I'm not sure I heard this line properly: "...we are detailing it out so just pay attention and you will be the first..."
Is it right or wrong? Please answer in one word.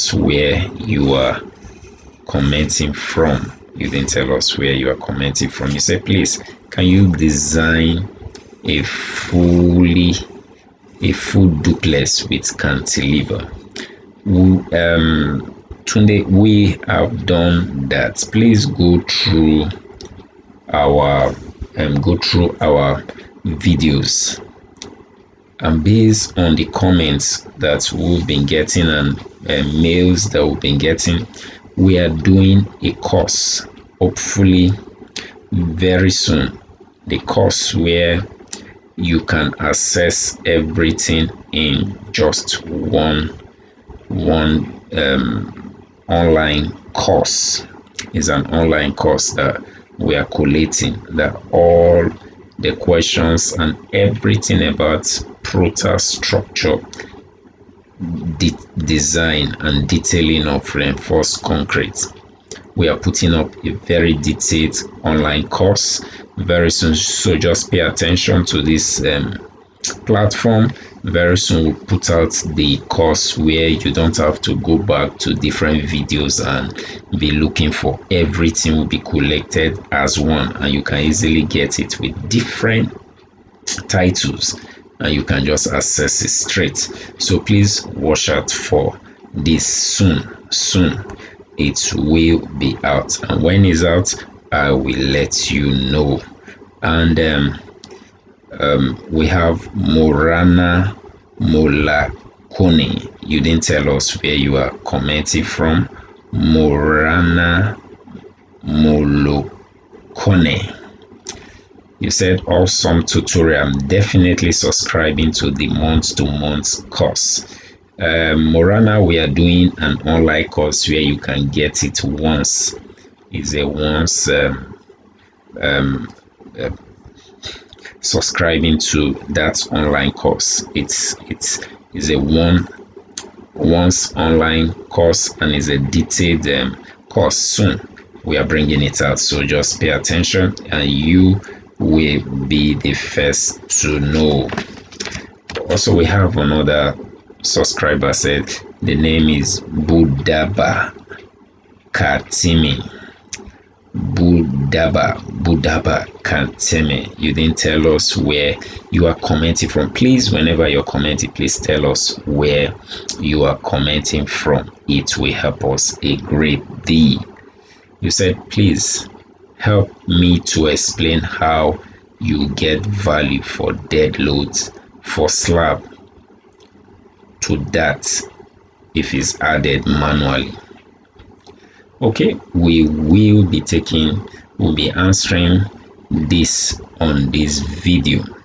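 wrong.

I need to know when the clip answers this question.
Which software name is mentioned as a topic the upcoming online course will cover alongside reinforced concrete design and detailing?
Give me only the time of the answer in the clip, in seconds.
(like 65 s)
55 s.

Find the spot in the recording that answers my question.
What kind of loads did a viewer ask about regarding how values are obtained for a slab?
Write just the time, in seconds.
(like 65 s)
173 s.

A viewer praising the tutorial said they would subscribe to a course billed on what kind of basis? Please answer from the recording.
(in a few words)
Month to month.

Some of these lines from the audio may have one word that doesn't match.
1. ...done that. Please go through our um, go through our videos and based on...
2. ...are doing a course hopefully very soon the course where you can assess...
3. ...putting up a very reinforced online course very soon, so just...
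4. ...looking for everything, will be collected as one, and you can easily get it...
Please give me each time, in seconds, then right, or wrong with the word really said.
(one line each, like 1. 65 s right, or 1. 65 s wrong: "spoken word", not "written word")
1. 17 s right
2. 31 s right
3. 62 s wrong: "detailed", not "reinforced"
4. 77 s right.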